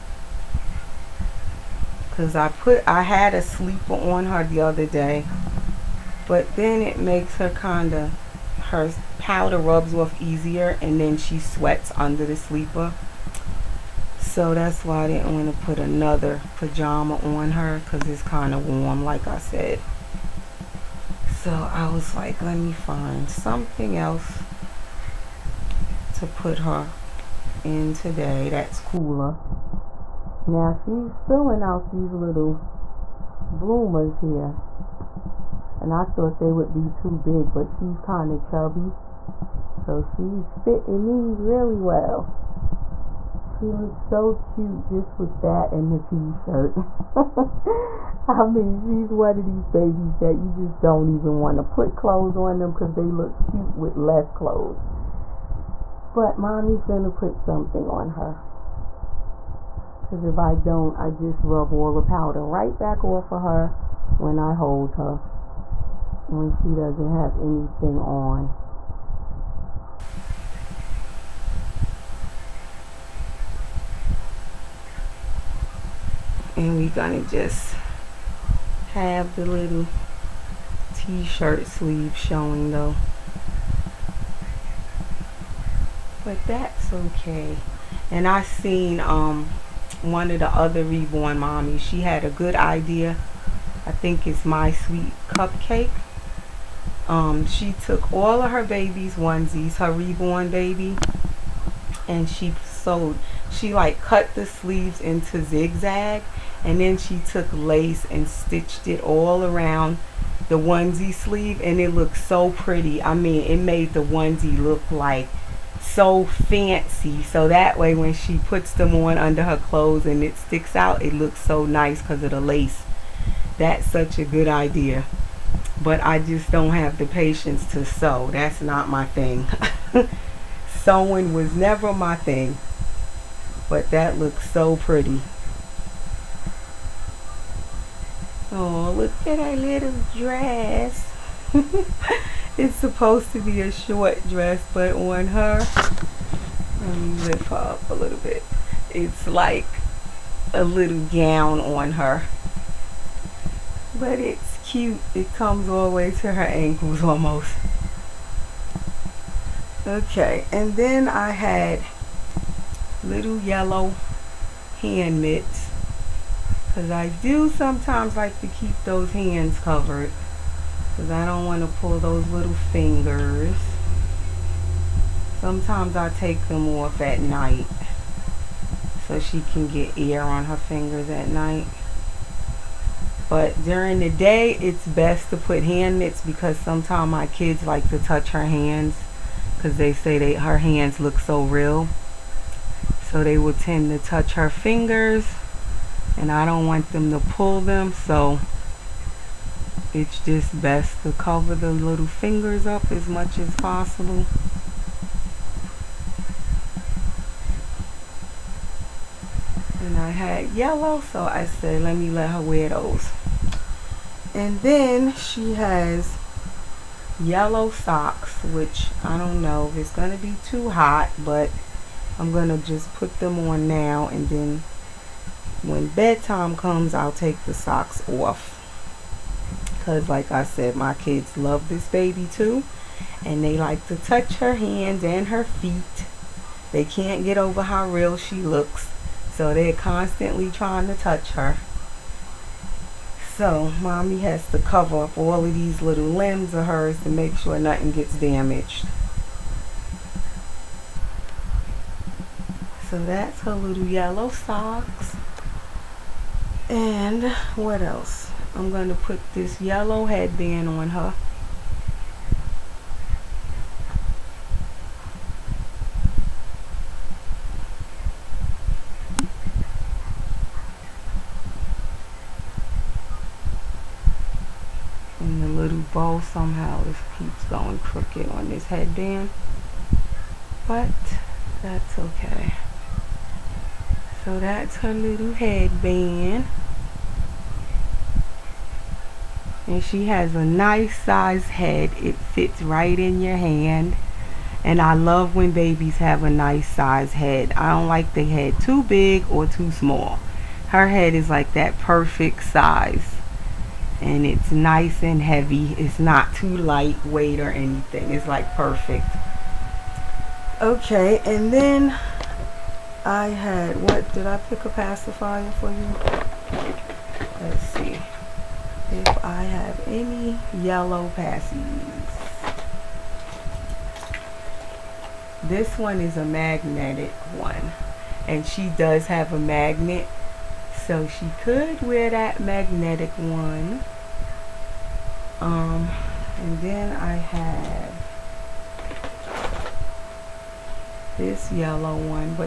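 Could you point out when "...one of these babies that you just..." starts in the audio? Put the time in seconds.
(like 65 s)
49 s.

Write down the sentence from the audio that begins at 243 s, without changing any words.
So mommy has to cover up all of these little limbs of hers to make sure nothing gets damaged.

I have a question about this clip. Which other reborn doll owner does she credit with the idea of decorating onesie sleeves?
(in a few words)
My Sweet Cupcake.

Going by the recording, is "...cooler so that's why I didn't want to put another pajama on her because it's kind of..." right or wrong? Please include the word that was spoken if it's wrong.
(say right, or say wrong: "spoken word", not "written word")
wrong: "sleeper", not "cooler".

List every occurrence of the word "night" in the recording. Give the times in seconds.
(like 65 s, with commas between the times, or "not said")
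177 s, 181 s.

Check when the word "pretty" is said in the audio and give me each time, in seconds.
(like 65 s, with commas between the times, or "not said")
112 s, 134 s.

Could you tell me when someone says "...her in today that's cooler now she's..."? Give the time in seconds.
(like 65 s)
26 s.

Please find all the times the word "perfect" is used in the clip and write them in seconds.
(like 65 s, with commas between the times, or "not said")
301 s, 308 s.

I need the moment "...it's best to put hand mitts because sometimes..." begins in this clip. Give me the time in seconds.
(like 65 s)
184 s.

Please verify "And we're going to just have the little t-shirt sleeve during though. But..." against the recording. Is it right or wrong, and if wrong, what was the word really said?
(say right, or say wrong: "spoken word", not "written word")
wrong: "showing", not "during".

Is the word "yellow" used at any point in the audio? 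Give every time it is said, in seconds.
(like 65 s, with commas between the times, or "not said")
163 s, 210 s, 217 s, 253 s, 259 s, 320 s, 341 s.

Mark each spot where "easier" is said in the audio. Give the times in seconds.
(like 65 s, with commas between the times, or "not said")
10 s.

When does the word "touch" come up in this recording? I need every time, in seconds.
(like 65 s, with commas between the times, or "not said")
187 s, 194 s, 233 s, 240 s.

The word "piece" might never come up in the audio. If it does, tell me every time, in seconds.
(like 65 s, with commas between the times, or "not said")
not said.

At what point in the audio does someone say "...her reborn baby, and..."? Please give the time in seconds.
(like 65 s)
99 s.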